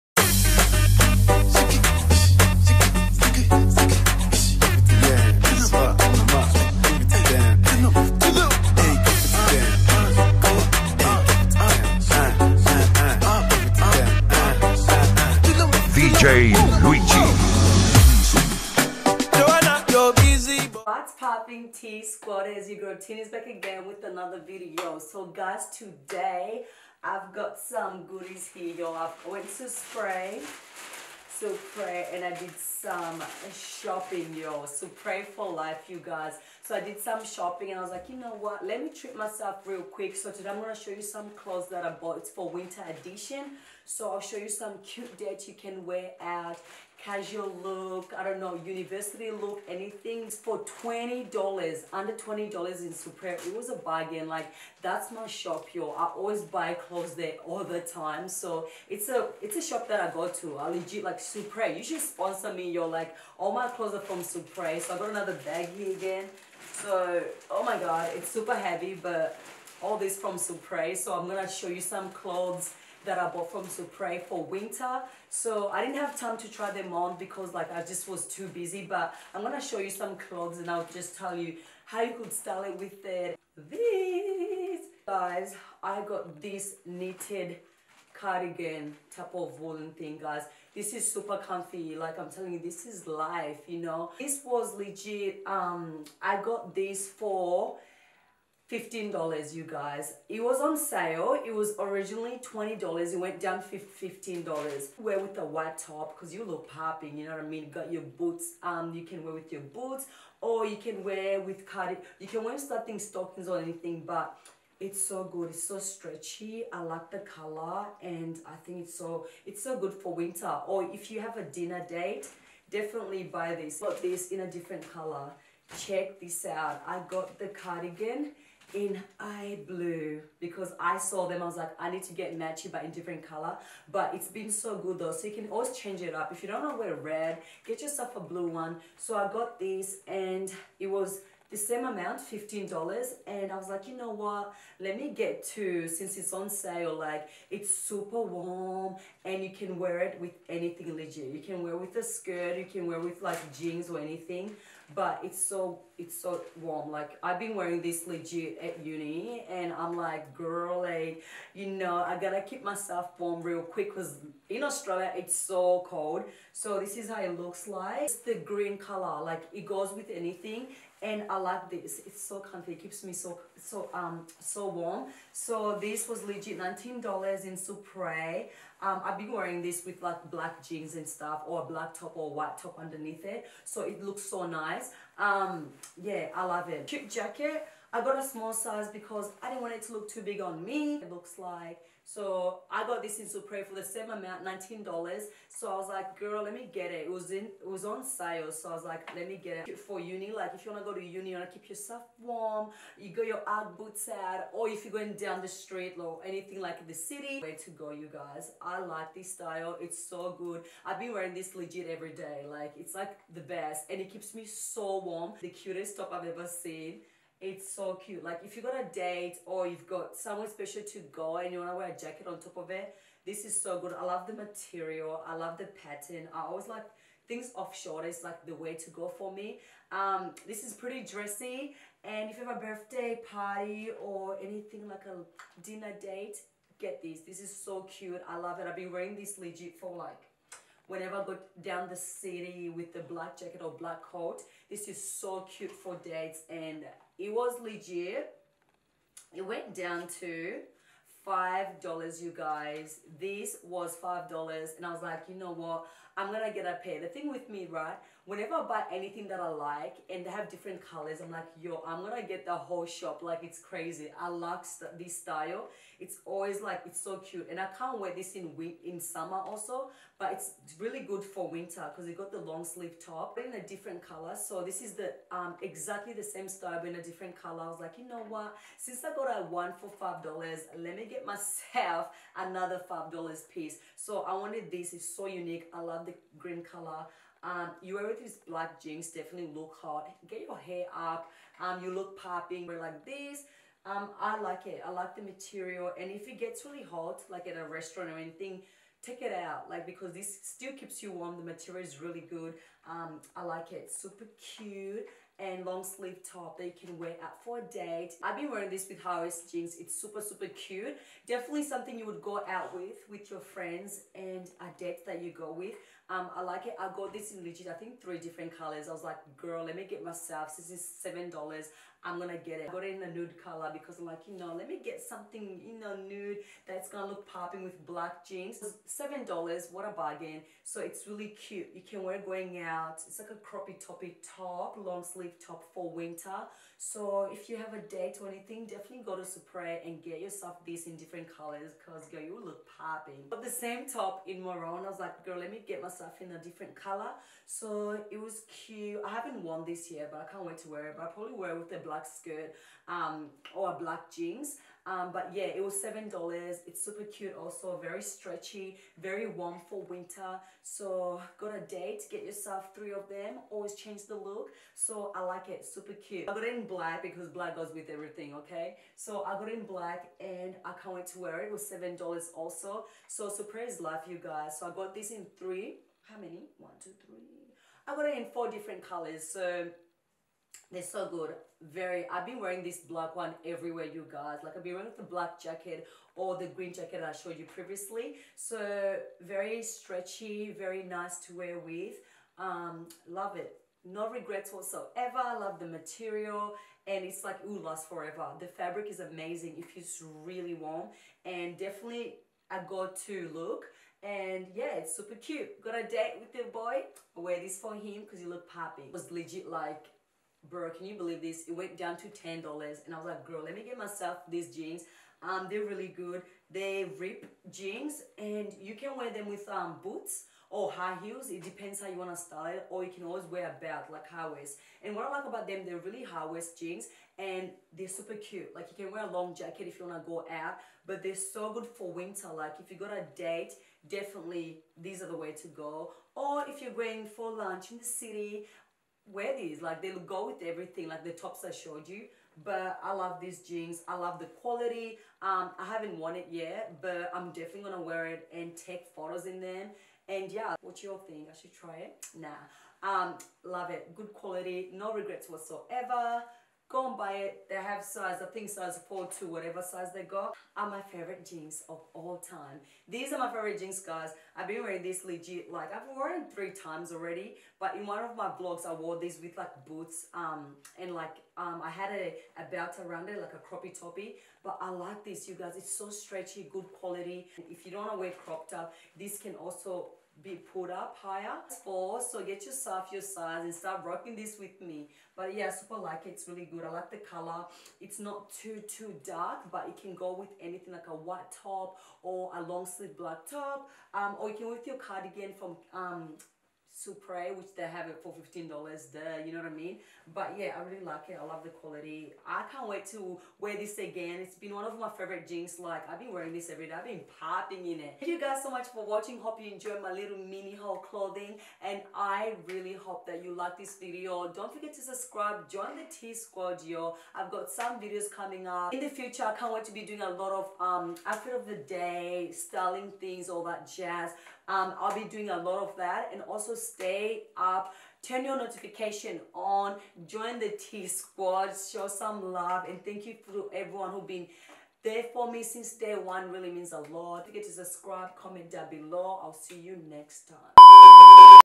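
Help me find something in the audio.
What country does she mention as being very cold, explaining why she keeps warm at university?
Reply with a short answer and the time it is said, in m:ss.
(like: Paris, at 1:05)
Australia, at 2:44.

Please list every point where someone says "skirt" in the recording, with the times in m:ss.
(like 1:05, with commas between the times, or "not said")
2:32, 5:52.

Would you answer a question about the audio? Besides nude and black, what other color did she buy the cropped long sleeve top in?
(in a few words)
Maroon.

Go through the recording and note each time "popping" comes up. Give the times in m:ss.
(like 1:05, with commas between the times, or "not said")
0:21, 1:46, 4:52, 5:27, 5:42, 8:27.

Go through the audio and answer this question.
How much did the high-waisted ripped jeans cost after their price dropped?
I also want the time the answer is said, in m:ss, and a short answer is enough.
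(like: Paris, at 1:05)
$10, at 6:51.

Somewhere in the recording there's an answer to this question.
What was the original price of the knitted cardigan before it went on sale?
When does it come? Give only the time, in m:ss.
1:41.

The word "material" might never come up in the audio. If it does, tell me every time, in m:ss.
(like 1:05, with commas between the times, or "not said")
3:44, 4:55, 5:01, 6:35.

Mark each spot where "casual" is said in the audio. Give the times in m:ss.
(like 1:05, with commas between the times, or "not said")
0:47.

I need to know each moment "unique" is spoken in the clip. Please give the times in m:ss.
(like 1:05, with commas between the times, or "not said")
4:45.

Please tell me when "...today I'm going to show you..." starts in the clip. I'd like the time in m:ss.
0:40.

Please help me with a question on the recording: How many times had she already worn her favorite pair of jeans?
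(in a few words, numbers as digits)
3.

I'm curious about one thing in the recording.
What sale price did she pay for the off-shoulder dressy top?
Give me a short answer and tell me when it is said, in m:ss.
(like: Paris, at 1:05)
$5, at 4:09.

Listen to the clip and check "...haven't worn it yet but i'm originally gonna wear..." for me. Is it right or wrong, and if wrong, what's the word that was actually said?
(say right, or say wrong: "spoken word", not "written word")
wrong: "definitely", not "originally".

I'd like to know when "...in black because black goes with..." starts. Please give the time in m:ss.
6:06.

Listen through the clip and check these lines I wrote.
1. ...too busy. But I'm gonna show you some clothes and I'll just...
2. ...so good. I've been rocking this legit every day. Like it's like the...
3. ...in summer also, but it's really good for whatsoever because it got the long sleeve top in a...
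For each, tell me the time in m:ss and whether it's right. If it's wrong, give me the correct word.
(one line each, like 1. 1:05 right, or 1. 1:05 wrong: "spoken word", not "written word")
1. 1:18 right
2. 3:30 wrong: "wearing", not "rocking"
3. 4:28 wrong: "winter", not "whatsoever".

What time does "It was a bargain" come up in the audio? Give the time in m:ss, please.
0:53.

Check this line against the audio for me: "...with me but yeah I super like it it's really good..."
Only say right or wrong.
right.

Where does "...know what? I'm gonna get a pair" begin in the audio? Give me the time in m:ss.
4:15.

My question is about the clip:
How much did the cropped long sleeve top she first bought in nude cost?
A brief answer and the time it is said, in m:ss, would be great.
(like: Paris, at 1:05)
$7, at 5:20.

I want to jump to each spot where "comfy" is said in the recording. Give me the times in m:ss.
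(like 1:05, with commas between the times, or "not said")
1:31, 2:52.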